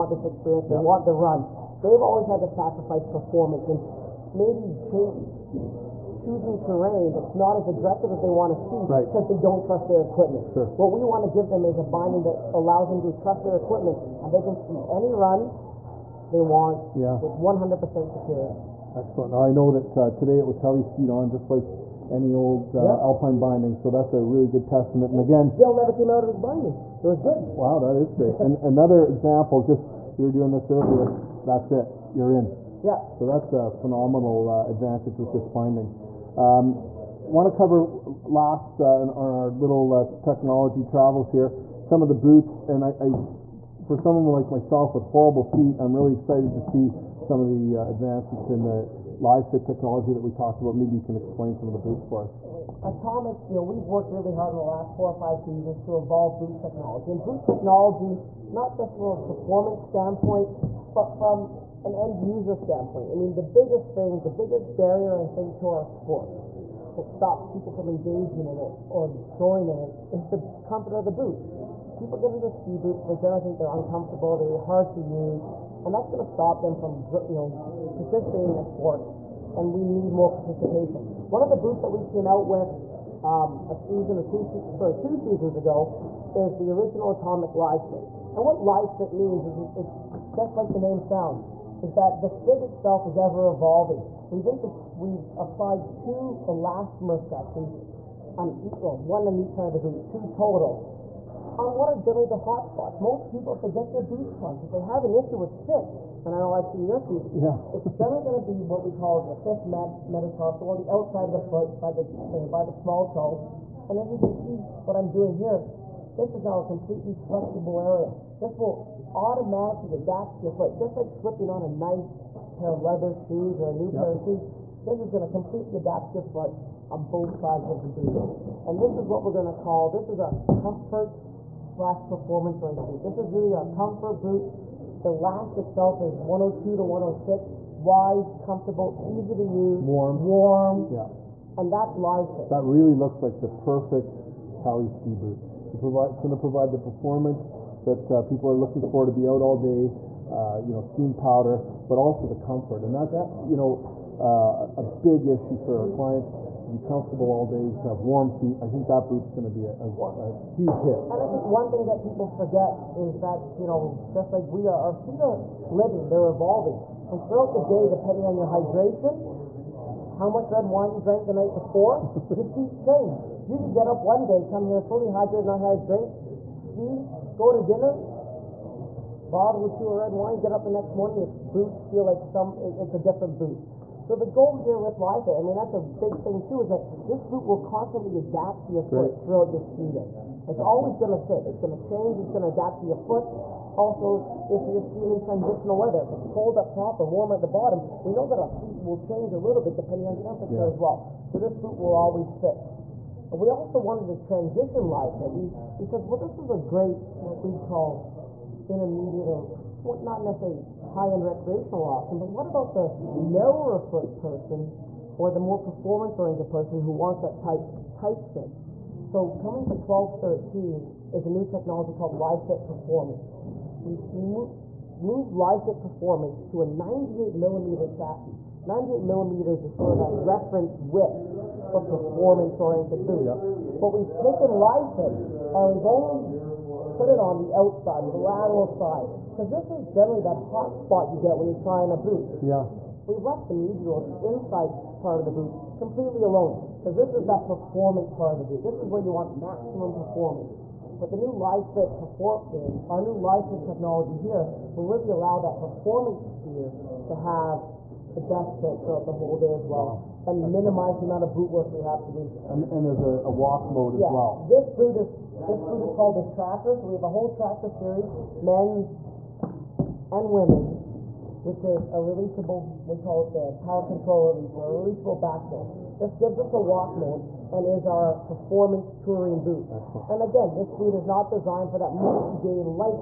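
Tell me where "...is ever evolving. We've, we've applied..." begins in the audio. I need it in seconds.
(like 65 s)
93 s.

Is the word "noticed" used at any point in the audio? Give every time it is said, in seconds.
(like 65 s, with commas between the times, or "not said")
not said.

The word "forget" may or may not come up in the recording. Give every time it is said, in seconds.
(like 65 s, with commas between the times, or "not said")
162 s.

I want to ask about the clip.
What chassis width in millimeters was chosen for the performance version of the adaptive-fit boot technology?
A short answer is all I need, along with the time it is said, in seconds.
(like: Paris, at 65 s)
98 millimeters, at 226 s.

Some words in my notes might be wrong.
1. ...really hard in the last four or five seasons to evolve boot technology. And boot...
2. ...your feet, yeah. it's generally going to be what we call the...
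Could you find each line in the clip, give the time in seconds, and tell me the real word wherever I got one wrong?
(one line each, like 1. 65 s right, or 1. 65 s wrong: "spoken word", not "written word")
1. 54 s right
2. 106 s right.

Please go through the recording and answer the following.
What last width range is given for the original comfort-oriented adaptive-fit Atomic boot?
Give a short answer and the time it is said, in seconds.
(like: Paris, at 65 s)
102 to 106, at 136 s.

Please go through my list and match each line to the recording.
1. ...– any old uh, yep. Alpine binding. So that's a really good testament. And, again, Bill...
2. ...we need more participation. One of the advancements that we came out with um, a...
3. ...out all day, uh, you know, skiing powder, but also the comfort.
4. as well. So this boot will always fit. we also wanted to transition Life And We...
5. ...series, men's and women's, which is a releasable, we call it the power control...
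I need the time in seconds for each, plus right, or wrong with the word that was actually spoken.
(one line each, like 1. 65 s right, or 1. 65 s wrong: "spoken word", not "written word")
1. 21 s right
2. 79 s wrong: "boots", not "advancements"
3. 149 s right
4. 200 s right
5. 267 s right.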